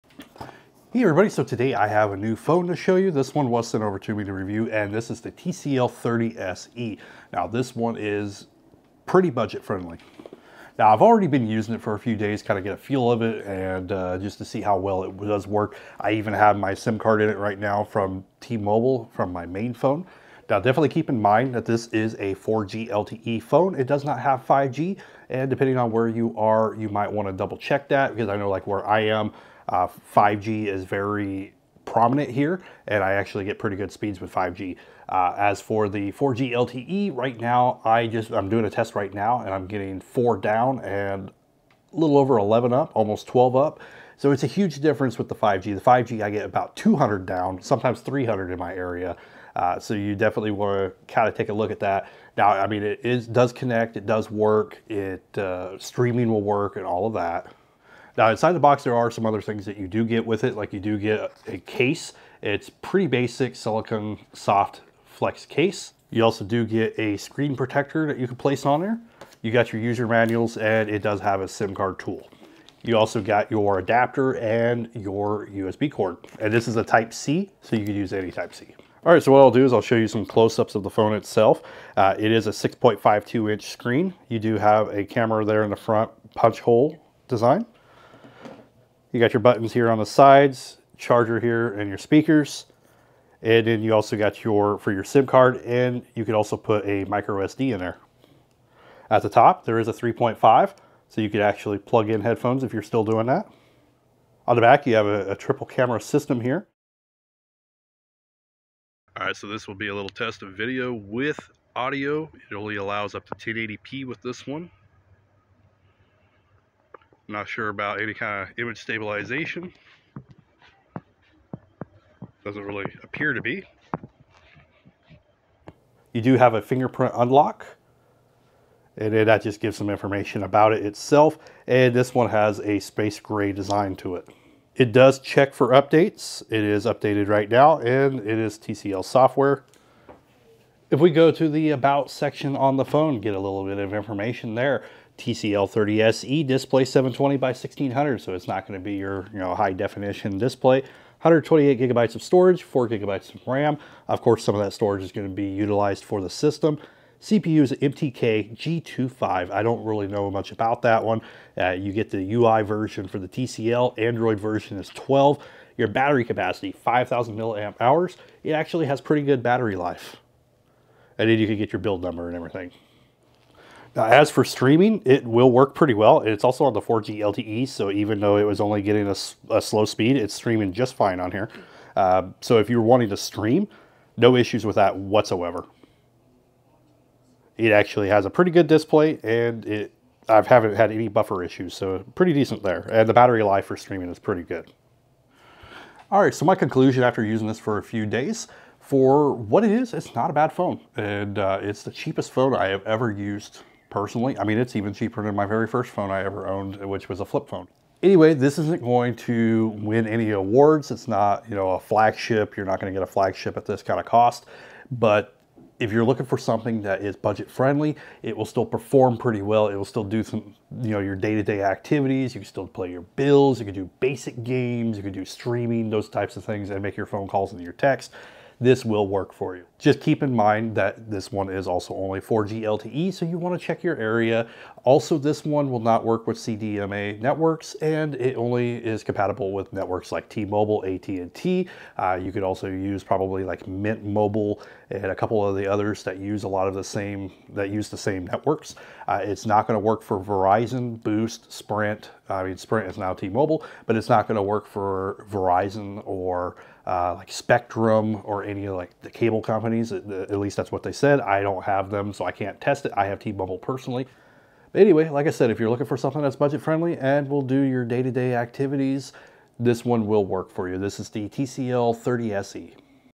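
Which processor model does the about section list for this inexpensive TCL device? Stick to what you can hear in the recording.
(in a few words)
MTK G25.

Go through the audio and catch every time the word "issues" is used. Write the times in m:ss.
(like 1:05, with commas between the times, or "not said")
3:04, 3:11.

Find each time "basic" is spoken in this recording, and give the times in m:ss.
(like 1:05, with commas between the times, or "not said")
1:03, 3:43.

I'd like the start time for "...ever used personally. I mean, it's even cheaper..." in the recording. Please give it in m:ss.
3:22.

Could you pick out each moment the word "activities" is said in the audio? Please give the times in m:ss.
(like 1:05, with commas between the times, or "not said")
3:41, 4:28.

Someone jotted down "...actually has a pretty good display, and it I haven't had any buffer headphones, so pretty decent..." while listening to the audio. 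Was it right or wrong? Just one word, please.
wrong.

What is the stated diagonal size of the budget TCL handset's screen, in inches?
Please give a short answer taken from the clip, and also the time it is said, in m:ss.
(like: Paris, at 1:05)
6.52, at 1:22.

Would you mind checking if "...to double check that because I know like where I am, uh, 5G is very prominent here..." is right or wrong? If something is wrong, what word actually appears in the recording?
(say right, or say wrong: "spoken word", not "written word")
right.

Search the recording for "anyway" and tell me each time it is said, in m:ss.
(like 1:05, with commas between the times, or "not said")
3:28, 4:24.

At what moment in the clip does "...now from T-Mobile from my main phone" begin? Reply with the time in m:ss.
0:17.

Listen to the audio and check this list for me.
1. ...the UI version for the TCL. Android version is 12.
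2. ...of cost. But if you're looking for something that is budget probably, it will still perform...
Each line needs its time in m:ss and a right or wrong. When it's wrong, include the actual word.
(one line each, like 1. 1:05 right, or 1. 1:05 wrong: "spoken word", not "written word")
1. 2:42 right
2. 3:33 wrong: "friendly", not "probably".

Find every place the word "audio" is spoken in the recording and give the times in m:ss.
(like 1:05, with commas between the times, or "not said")
1:51.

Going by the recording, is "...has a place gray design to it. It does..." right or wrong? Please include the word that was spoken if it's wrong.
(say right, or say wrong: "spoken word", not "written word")
wrong: "space", not "place".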